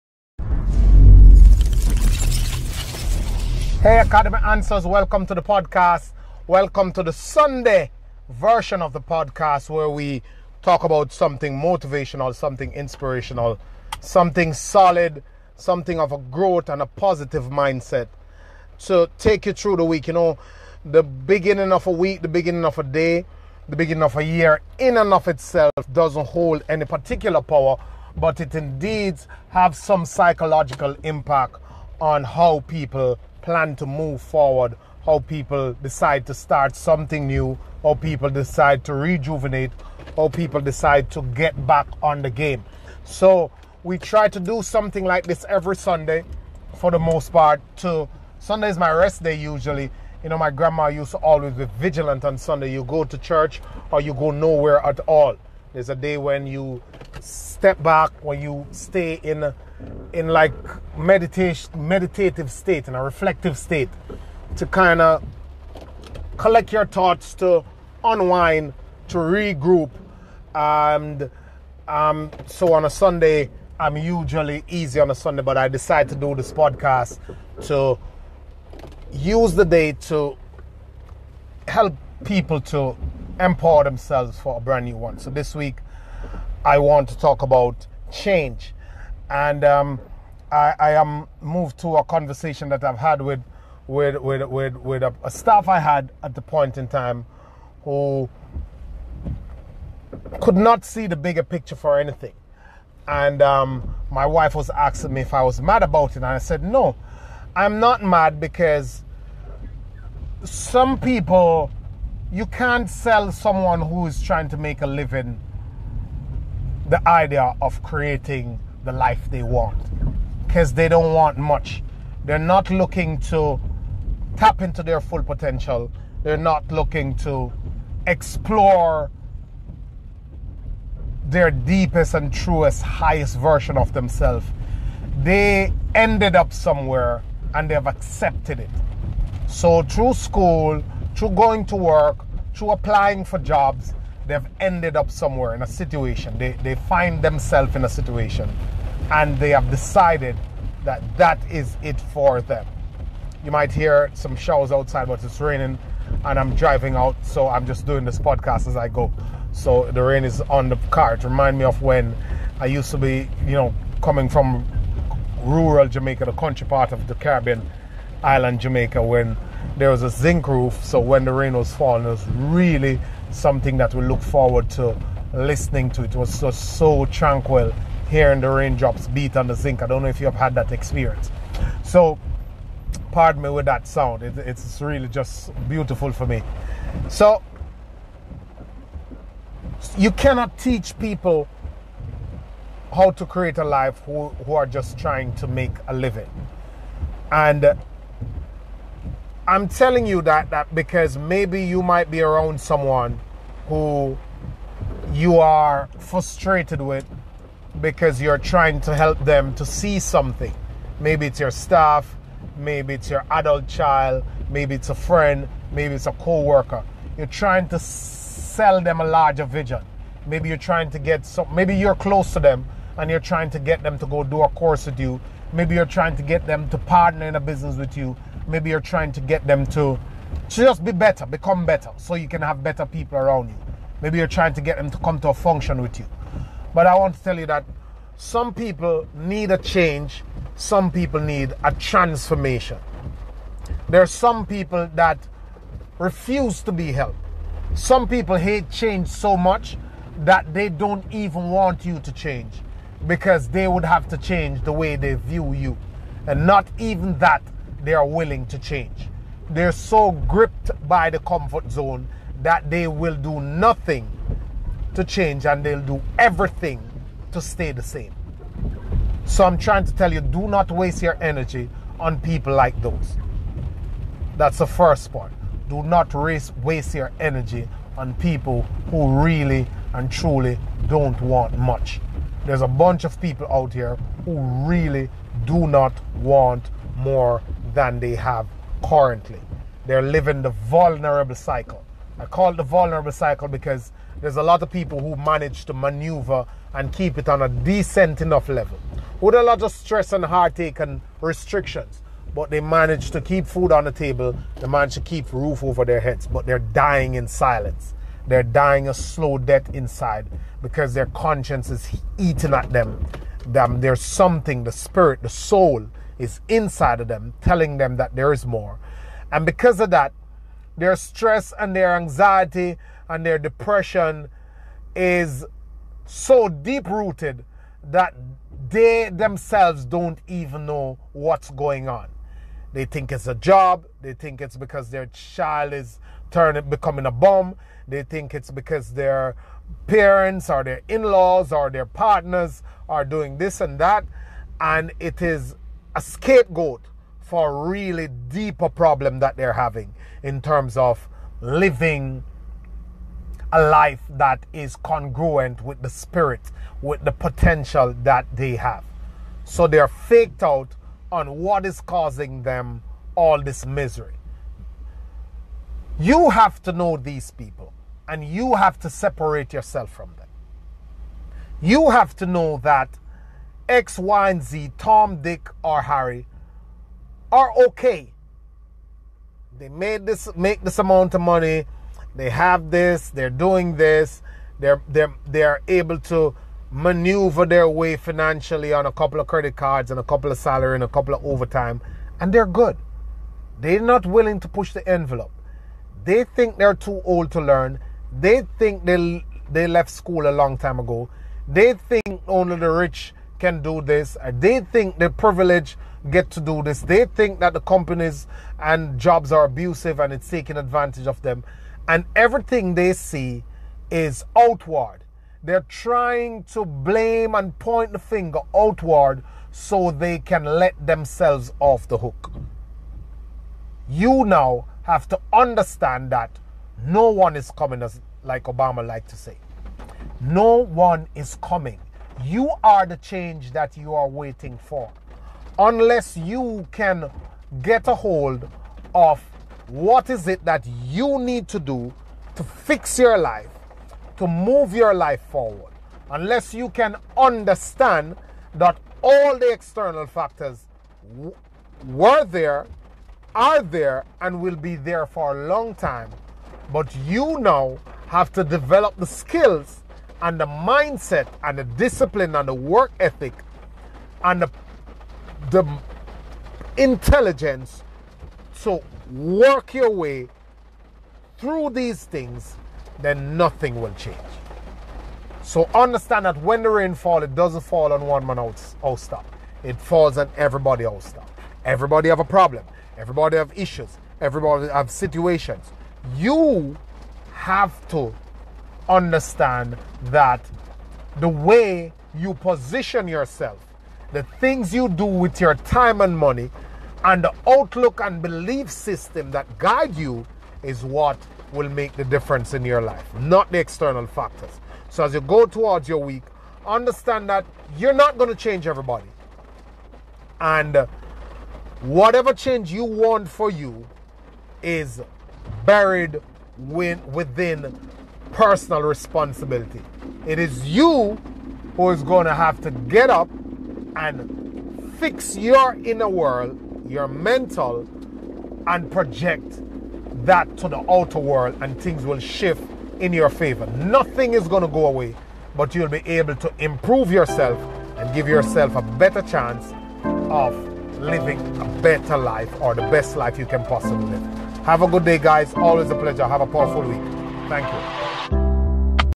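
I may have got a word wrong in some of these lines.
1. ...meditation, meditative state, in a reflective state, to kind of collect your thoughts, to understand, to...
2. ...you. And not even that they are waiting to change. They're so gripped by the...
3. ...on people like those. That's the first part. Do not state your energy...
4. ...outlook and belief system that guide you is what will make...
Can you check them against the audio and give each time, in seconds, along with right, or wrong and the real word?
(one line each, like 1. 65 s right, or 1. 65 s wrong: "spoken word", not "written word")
1. 60 s wrong: "unwind", not "understand"
2. 255 s wrong: "willing", not "waiting"
3. 271 s wrong: "waste", not "state"
4. 497 s right.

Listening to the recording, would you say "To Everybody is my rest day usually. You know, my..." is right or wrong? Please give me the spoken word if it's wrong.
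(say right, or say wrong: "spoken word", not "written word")
wrong: "Sunday", not "Everybody".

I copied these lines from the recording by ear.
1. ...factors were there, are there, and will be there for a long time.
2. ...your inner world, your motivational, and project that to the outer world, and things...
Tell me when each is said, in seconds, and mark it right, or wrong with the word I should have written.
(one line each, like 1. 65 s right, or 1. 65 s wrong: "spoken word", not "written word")
1. 450 s right
2. 525 s wrong: "mental", not "motivational".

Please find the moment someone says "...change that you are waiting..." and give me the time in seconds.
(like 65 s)
432 s.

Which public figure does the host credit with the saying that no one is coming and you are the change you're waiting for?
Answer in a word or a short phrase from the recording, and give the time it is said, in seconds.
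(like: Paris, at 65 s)
Obama, at 428 s.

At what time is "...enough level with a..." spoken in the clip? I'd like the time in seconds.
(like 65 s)
298 s.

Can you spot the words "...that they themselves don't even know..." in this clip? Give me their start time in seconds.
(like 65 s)
327 s.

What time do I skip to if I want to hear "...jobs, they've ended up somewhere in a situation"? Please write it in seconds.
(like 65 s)
143 s.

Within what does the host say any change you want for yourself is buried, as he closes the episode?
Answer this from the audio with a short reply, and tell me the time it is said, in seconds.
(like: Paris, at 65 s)
personal responsibility, at 518 s.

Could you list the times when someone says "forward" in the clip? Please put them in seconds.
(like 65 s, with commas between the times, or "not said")
34 s, 174 s, 445 s.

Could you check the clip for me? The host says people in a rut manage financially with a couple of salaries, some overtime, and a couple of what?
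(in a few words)
credit cards.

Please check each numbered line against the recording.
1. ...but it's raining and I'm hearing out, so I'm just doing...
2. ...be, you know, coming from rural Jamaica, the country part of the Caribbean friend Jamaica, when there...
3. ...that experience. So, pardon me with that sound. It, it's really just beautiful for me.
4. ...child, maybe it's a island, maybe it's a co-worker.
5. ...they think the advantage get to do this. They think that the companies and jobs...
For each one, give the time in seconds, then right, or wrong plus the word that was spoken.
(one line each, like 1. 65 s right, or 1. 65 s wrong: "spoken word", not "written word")
1. 155 s wrong: "driving", not "hearing"
2. 162 s wrong: "island", not "friend"
3. 180 s right
4. 213 s wrong: "friend", not "island"
5. 404 s wrong: "privilege", not "advantage".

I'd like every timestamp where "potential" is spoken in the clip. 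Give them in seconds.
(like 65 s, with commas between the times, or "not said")
125 s, 357 s.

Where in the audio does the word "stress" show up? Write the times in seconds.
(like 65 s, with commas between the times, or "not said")
299 s, 320 s.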